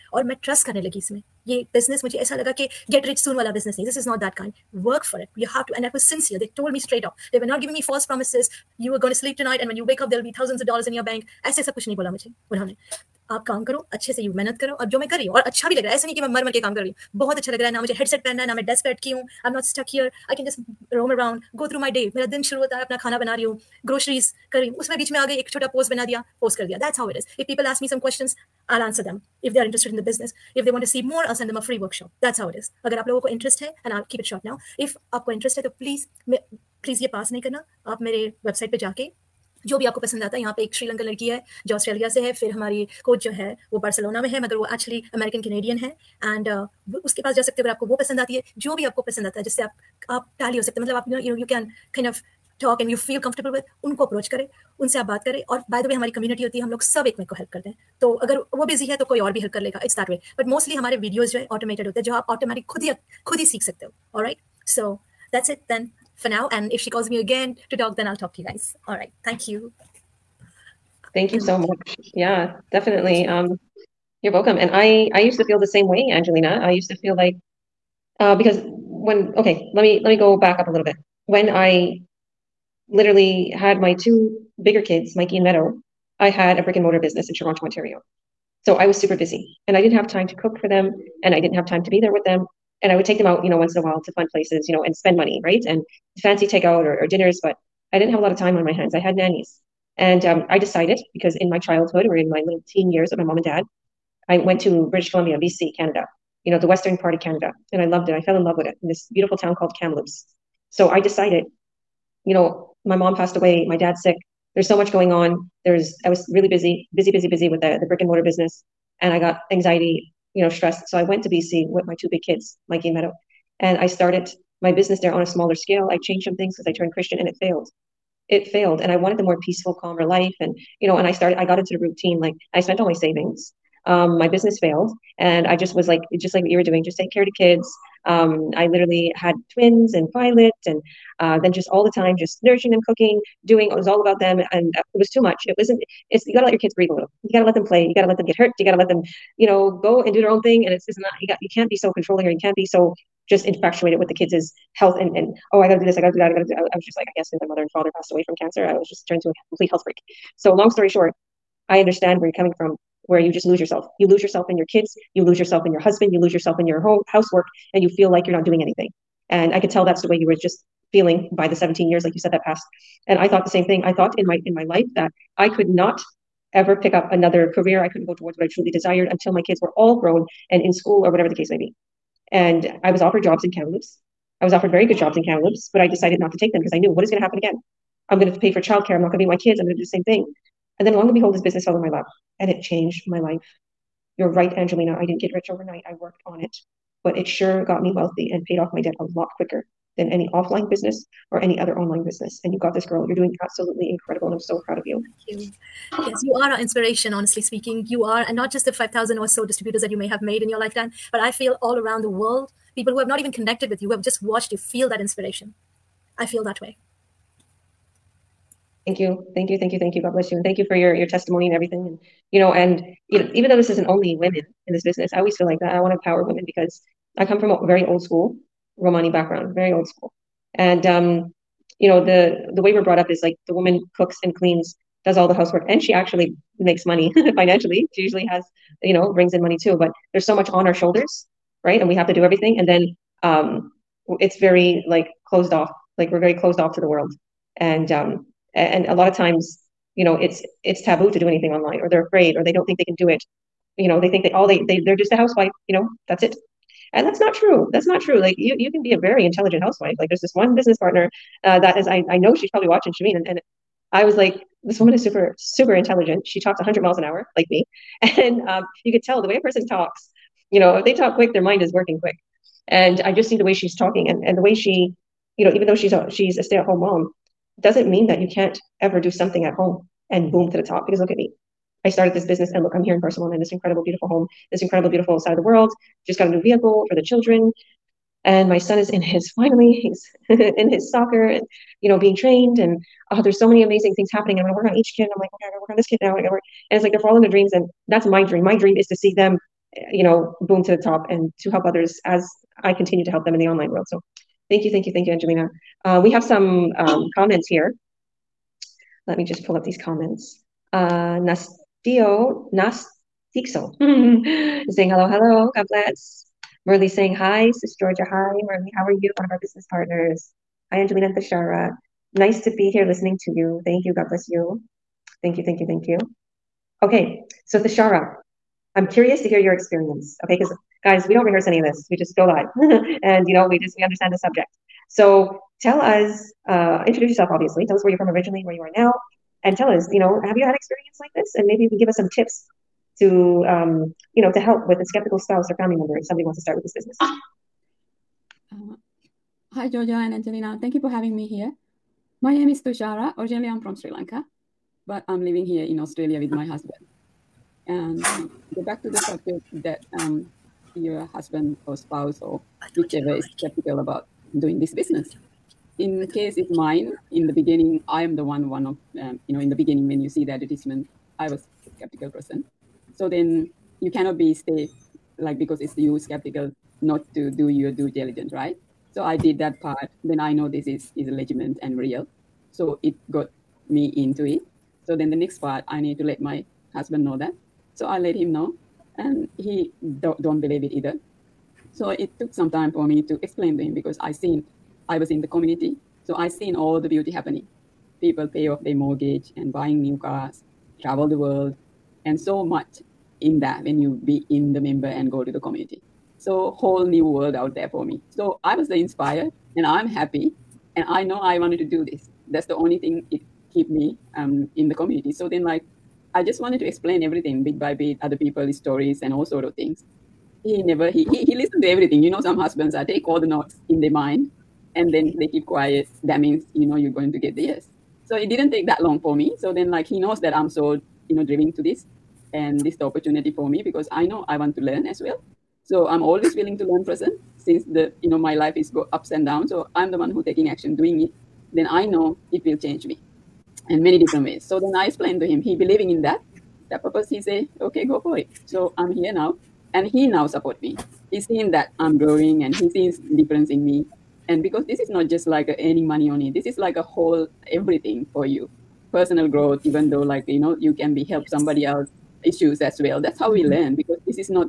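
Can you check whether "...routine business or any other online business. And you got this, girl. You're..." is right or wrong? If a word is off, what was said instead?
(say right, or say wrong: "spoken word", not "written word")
wrong: "offline", not "routine".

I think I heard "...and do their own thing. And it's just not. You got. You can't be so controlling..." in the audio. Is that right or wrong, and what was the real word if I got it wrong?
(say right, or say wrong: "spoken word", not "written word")
right.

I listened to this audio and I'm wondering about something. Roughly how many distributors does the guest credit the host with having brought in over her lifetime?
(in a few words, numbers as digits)
5,000.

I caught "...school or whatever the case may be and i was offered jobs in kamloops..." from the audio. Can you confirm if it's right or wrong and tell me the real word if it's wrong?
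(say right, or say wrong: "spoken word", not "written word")
right.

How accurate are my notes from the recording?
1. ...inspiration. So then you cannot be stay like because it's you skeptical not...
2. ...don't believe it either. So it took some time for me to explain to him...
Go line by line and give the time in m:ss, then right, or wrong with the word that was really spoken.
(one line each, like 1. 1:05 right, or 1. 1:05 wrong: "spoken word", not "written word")
1. 6:12 wrong: "person", not "inspiration"
2. 6:30 right.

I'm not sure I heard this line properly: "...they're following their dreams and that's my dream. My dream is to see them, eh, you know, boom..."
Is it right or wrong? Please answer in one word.
right.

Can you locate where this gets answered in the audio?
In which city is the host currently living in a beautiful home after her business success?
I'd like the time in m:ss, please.
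4:43.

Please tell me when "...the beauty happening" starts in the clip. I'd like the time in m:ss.
6:36.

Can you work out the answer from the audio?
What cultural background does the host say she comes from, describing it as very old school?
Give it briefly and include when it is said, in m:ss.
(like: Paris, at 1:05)
Romani, at 3:48.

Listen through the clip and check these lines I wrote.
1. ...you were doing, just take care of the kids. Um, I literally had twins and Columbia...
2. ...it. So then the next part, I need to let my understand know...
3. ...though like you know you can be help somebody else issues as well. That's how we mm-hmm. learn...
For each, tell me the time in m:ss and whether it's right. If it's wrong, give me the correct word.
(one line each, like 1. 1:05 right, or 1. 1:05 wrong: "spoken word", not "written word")
1. 2:16 wrong: "Violet", not "Columbia"
2. 6:24 wrong: "husband", not "understand"
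3. 7:39 right.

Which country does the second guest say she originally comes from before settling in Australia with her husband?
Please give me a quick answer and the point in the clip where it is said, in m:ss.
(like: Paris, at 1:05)
Sri Lanka, at 5:53.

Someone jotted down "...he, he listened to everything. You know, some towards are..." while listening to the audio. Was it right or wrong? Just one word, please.
wrong.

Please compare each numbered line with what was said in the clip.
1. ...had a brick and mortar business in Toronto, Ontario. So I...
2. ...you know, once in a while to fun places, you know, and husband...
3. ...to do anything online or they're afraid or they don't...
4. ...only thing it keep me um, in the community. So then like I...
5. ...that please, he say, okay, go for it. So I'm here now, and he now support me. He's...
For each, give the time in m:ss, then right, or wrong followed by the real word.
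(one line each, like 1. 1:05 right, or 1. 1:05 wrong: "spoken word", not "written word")
1. 1:26 right
2. 1:33 wrong: "spend", not "husband"
3. 4:11 right
4. 6:52 right
5. 7:26 wrong: "purpose", not "please".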